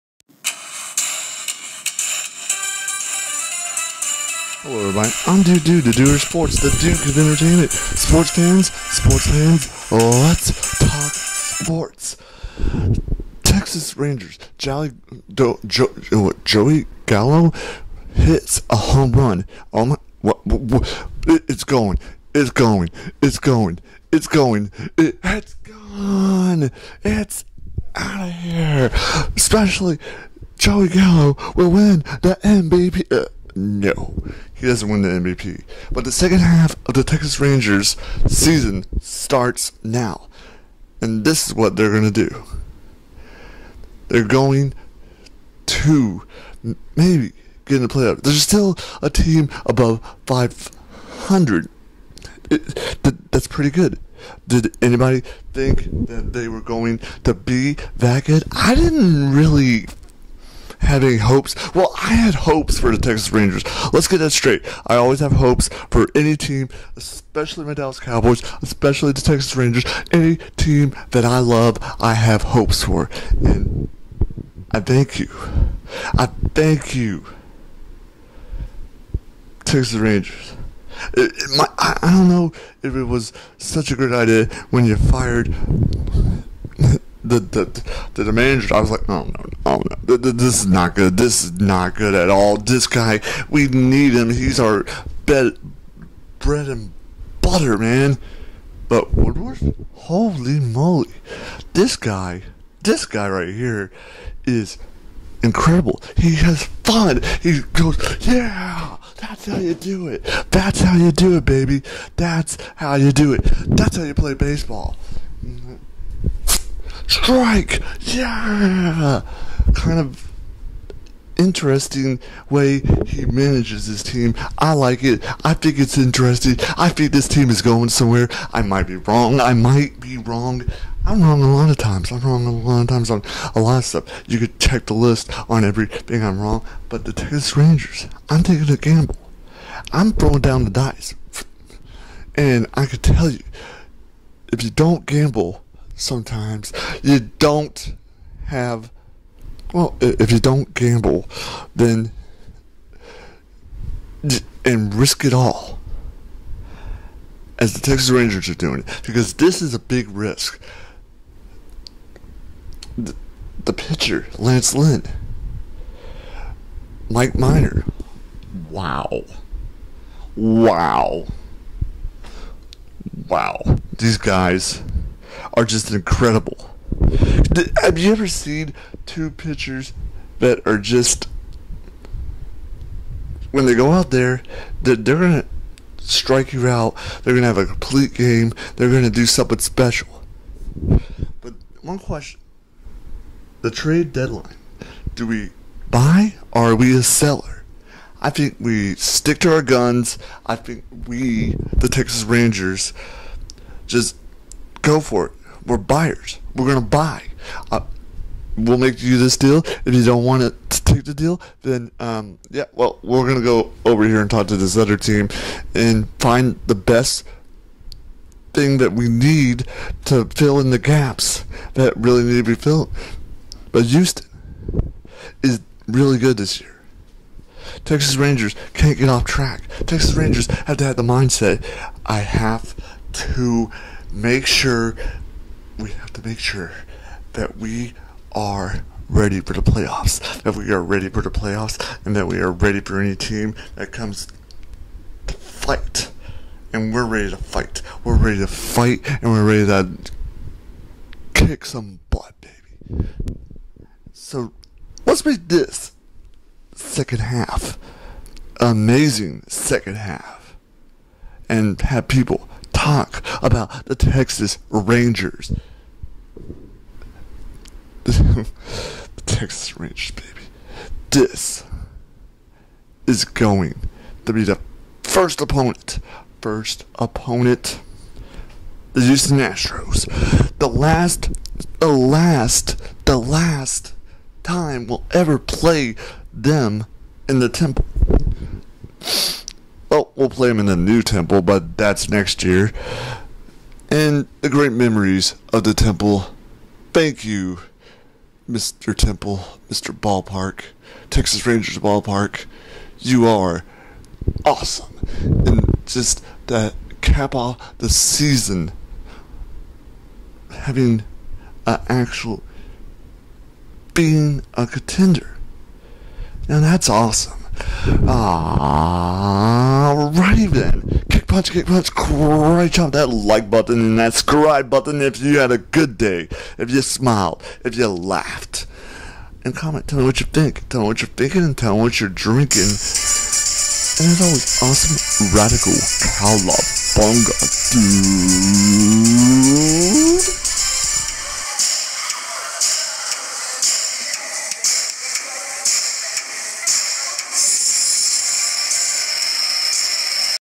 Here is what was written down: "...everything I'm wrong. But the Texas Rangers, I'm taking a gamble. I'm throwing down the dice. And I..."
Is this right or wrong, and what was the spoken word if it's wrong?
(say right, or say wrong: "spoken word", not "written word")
right.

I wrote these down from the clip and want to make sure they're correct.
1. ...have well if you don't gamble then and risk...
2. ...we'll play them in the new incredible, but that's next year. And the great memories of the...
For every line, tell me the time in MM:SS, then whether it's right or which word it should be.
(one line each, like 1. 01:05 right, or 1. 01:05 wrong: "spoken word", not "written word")
1. 02:28 right
2. 04:50 wrong: "temple", not "incredible".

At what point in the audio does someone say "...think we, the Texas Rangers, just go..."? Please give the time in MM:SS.
03:20.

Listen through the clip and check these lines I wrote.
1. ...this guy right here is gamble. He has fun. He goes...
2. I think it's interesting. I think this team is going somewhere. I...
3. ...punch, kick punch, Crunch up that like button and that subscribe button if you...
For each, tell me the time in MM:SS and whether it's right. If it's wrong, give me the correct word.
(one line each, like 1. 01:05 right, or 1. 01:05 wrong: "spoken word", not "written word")
1. 01:42 wrong: "incredible", not "gamble"
2. 02:05 right
3. 05:21 right.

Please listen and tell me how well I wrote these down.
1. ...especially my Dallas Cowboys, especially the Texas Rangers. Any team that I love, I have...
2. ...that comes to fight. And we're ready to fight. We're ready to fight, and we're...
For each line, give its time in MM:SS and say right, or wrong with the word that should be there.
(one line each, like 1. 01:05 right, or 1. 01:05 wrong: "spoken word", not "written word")
1. 01:06 right
2. 04:03 right.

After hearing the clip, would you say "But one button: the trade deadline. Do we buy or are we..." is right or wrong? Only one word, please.
wrong.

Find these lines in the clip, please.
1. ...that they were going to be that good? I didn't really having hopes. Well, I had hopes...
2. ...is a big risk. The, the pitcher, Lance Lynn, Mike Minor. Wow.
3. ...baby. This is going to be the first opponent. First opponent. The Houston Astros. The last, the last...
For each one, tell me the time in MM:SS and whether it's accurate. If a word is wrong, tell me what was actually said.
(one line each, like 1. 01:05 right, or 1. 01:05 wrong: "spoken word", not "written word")
1. 00:56 right
2. 02:39 right
3. 04:30 right.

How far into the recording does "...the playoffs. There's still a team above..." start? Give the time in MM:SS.
00:47.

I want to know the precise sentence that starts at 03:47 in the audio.
Texas Rangers can't get off track.